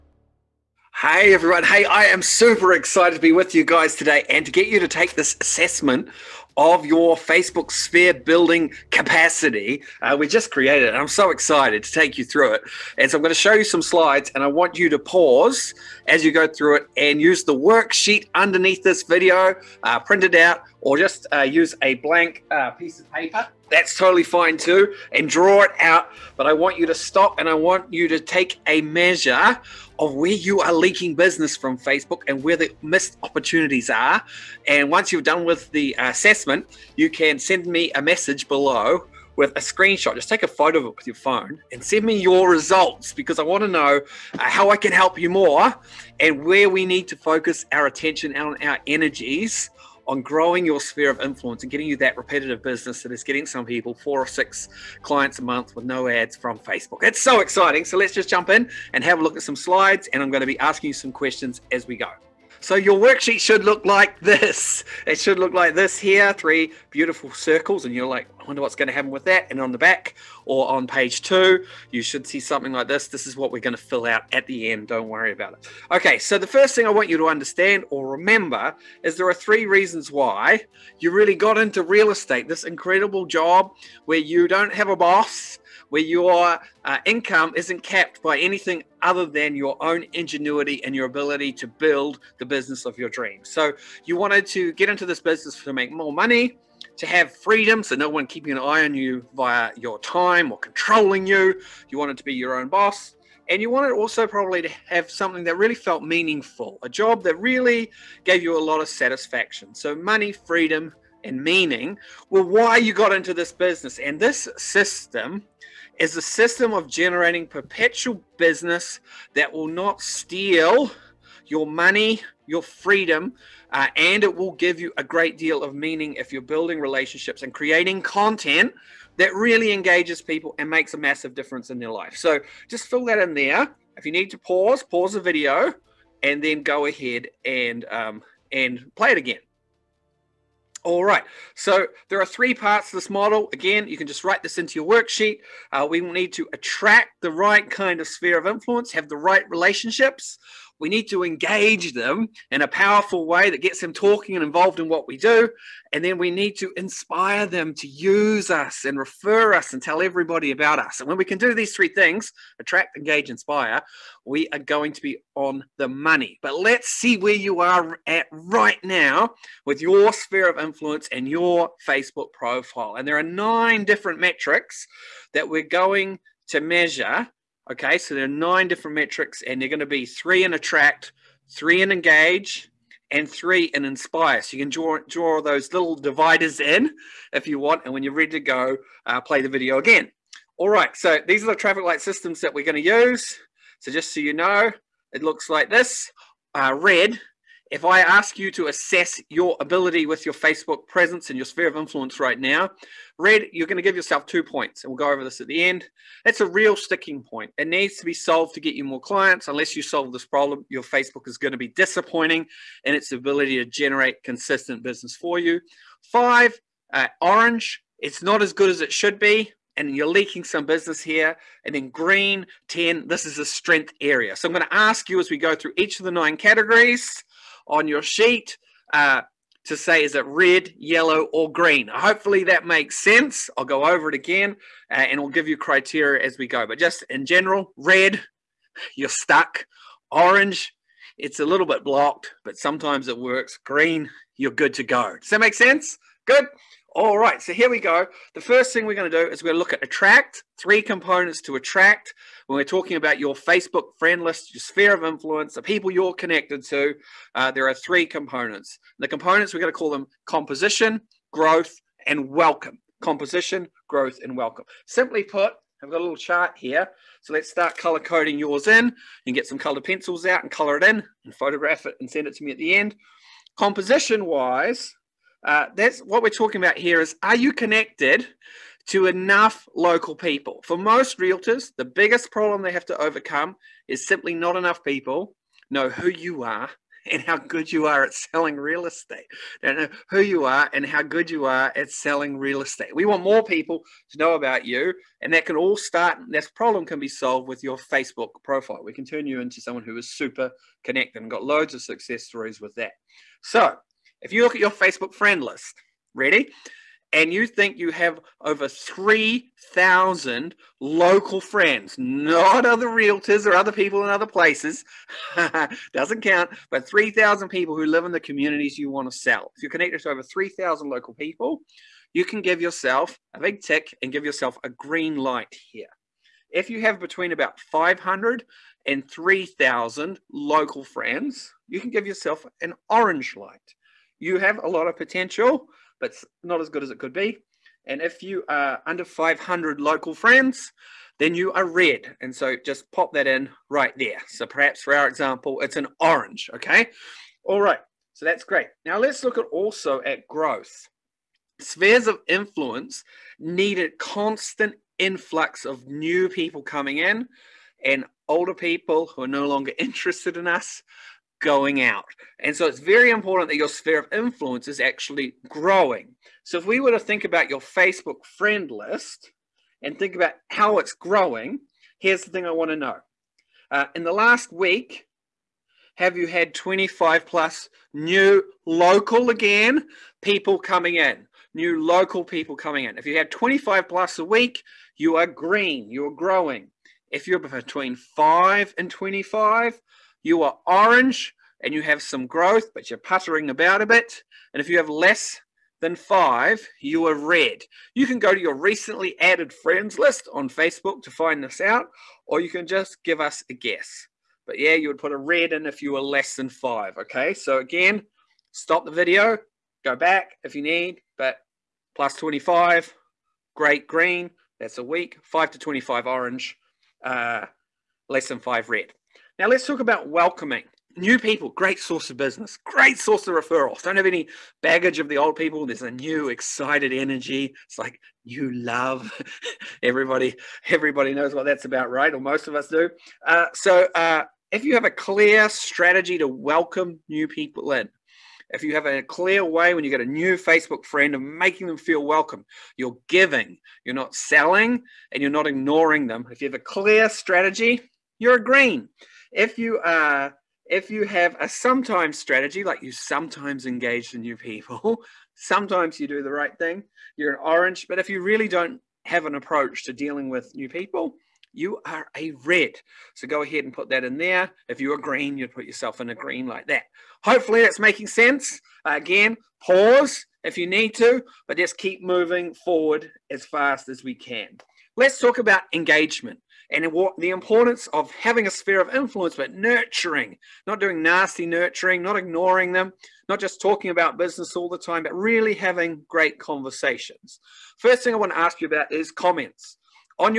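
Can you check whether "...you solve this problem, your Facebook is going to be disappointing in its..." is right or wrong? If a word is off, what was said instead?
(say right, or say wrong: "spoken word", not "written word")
right.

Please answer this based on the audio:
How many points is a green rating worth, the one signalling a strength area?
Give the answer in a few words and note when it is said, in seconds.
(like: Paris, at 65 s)
10, at 222 s.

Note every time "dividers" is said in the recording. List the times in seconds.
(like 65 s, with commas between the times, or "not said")
185 s.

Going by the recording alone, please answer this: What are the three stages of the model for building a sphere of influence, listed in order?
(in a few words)
Attract, engage, inspire.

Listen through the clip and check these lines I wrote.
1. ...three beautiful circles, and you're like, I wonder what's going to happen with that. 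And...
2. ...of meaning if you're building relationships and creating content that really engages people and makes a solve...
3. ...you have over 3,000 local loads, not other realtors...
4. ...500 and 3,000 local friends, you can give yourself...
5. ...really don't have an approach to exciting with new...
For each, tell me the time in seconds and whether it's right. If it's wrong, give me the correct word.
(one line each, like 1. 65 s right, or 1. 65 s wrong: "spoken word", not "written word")
1. 66 s right
2. 125 s wrong: "massive", not "solve"
3. 307 s wrong: "friends", not "loads"
4. 327 s right
5. 458 s wrong: "dealing", not "exciting".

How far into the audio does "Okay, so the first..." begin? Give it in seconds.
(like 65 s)
75 s.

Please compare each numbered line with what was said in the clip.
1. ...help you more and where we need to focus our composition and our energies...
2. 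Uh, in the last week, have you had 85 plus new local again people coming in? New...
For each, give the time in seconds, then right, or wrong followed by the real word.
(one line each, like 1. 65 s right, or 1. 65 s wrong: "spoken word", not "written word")
1. 44 s wrong: "attention", not "composition"
2. 373 s wrong: "25", not "85".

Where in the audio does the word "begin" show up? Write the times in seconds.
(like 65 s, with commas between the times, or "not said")
not said.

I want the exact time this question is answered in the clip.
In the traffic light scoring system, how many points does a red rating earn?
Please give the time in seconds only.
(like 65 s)
204 s.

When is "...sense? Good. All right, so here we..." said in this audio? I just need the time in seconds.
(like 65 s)
245 s.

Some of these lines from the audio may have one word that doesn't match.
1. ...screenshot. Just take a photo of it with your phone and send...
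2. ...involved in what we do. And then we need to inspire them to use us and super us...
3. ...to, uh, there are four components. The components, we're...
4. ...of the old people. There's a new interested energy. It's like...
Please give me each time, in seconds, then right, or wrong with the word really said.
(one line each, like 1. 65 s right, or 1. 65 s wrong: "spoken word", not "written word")
1. 39 s right
2. 154 s wrong: "refer", not "super"
3. 256 s wrong: "three", not "four"
4. 424 s wrong: "excited", not "interested".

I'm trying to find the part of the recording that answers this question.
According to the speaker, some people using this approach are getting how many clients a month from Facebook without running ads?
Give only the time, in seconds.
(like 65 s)
53 s.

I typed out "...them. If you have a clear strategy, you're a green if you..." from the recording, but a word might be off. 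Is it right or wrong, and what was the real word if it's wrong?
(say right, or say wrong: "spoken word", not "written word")
right.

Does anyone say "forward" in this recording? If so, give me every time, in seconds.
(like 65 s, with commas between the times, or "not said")
472 s.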